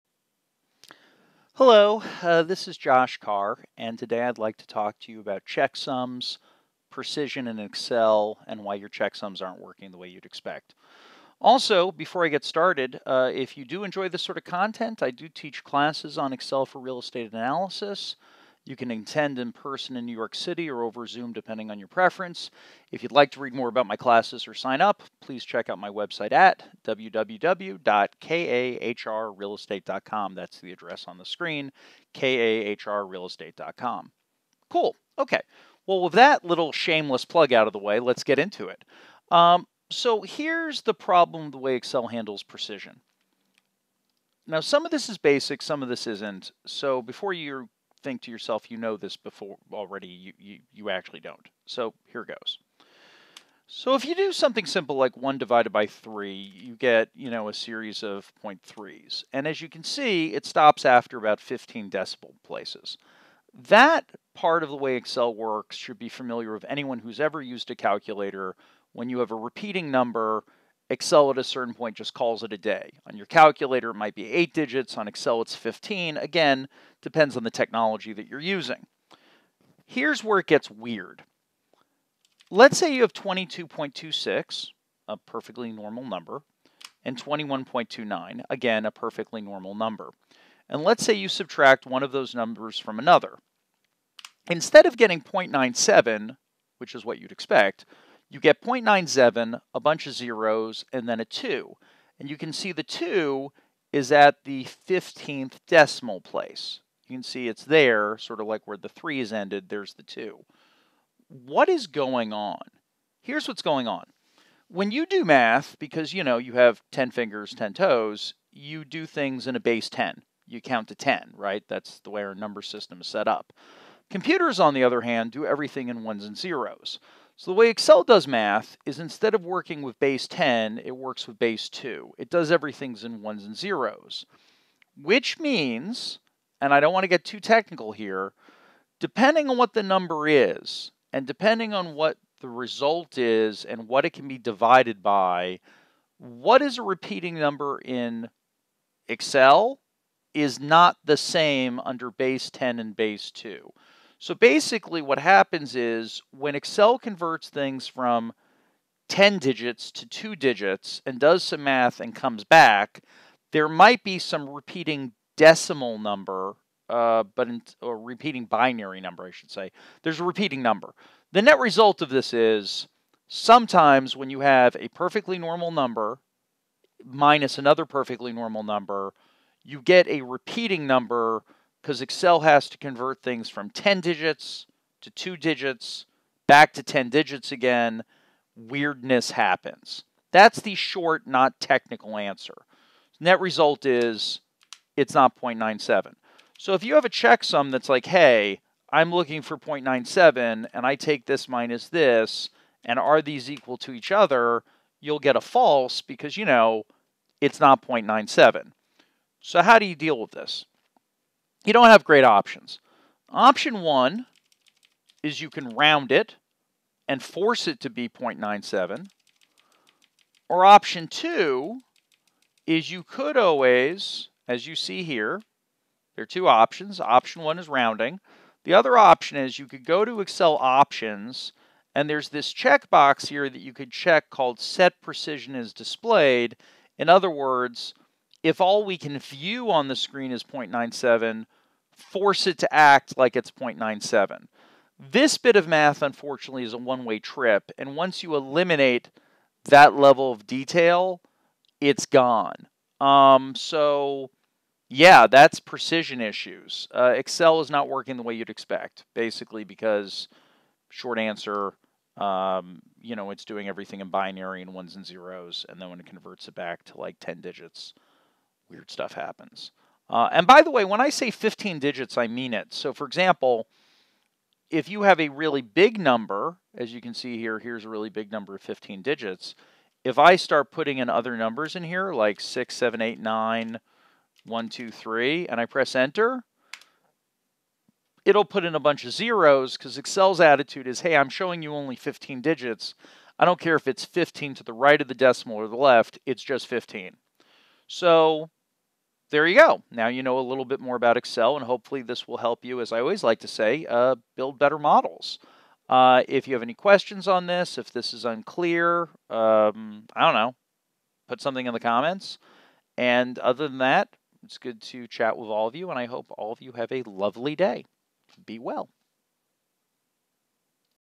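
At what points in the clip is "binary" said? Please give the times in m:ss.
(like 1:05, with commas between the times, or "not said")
2:48, 4:24.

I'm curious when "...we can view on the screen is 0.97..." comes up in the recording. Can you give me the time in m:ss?
3:58.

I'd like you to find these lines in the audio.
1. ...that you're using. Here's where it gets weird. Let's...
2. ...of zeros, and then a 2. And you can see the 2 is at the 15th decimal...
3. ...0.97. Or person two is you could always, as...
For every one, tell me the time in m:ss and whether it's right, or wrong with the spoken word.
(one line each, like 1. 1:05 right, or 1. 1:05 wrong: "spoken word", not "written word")
1. 1:18 right
2. 1:40 right
3. 3:38 wrong: "option", not "person".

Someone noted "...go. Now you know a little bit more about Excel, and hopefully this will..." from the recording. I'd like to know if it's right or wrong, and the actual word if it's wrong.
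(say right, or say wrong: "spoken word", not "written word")
right.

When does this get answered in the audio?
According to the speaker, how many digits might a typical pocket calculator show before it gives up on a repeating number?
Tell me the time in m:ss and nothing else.
1:14.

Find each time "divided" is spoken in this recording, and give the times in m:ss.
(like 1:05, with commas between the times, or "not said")
0:55, 2:24.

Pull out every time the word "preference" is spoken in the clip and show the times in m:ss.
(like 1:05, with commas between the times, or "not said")
0:21.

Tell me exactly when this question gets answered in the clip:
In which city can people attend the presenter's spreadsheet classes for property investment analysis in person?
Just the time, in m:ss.
0:20.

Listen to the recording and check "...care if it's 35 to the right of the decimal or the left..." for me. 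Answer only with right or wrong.
wrong.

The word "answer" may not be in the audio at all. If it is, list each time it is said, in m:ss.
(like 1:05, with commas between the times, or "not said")
3:12, 4:21.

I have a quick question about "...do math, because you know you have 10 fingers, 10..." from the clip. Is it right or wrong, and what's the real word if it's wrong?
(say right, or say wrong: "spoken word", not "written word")
right.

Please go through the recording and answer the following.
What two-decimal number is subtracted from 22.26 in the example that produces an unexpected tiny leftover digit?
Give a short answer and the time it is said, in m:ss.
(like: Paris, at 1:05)
21.29, at 1:27.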